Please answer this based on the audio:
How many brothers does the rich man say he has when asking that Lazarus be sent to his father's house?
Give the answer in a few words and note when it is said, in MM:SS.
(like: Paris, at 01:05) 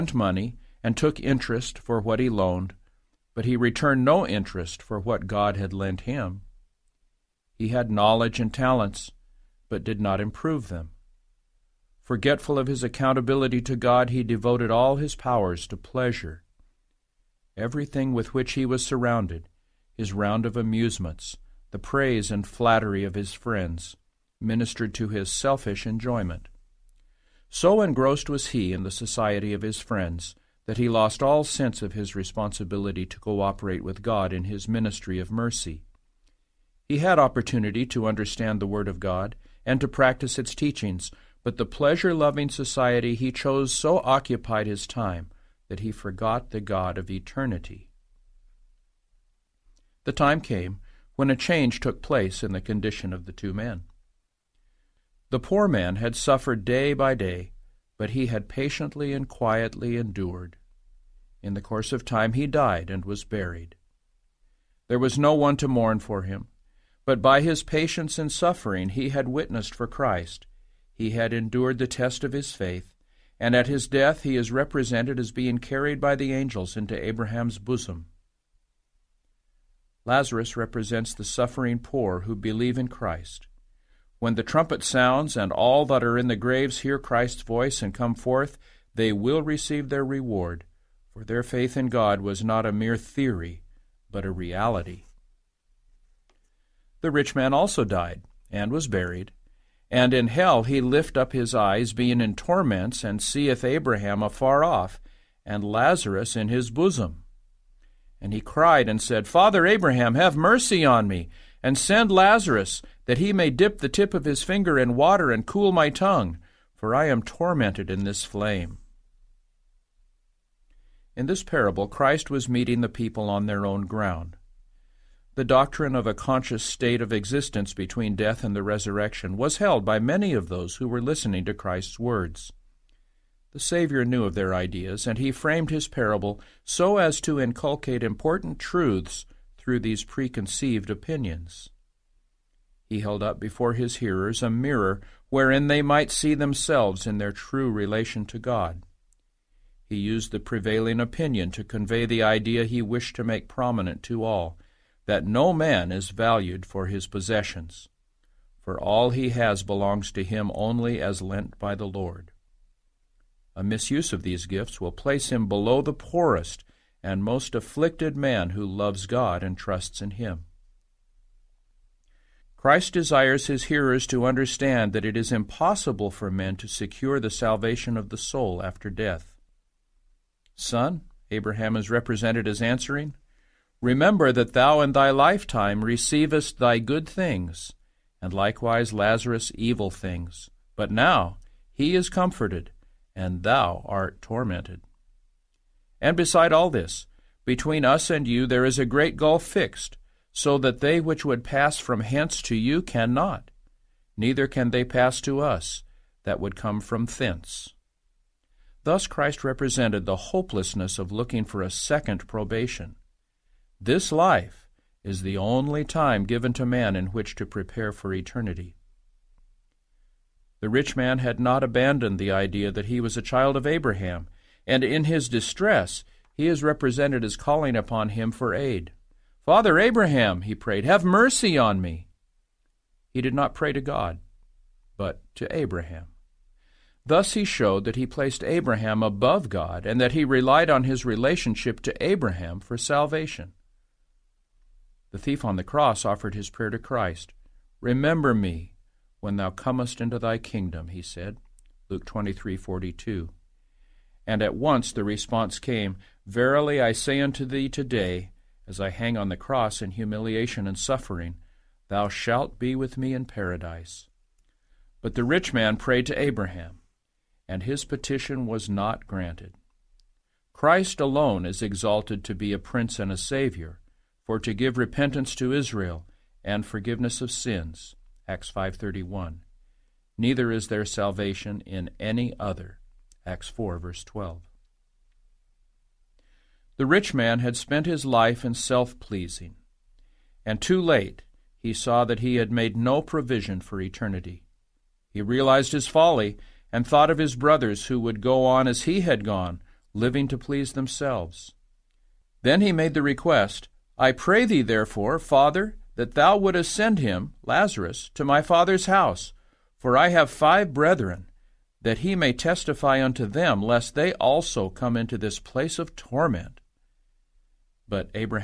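5, at 05:10.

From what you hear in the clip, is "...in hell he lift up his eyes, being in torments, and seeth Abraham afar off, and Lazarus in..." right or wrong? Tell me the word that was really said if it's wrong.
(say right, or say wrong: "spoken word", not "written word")
right.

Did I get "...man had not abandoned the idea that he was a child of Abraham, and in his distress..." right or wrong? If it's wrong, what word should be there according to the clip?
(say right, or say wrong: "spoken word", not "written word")
right.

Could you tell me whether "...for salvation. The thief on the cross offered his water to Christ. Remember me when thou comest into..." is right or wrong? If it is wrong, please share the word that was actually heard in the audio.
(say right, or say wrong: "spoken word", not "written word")
wrong: "prayer", not "water".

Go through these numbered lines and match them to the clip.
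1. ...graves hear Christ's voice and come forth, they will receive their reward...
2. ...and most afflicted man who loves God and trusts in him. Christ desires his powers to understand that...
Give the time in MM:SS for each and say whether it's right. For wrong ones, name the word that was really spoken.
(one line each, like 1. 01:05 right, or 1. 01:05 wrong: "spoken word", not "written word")
1. 01:26 right
2. 02:47 wrong: "hearers", not "powers".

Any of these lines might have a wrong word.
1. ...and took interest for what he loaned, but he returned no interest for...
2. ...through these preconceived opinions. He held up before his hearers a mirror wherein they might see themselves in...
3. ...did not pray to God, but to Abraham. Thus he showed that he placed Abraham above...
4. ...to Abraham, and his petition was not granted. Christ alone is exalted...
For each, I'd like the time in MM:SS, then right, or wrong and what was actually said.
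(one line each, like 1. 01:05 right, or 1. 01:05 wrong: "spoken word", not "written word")
1. 00:00 right
2. 02:19 right
3. 03:53 right
4. 04:26 right.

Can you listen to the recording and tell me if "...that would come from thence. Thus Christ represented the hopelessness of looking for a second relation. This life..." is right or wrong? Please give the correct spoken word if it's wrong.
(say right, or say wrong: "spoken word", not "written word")
wrong: "probation", not "relation".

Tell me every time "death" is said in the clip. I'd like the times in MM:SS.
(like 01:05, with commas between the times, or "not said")
01:13, 02:08, 02:58.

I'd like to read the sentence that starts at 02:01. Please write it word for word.
In this parable, Christ was meeting the people on their own ground.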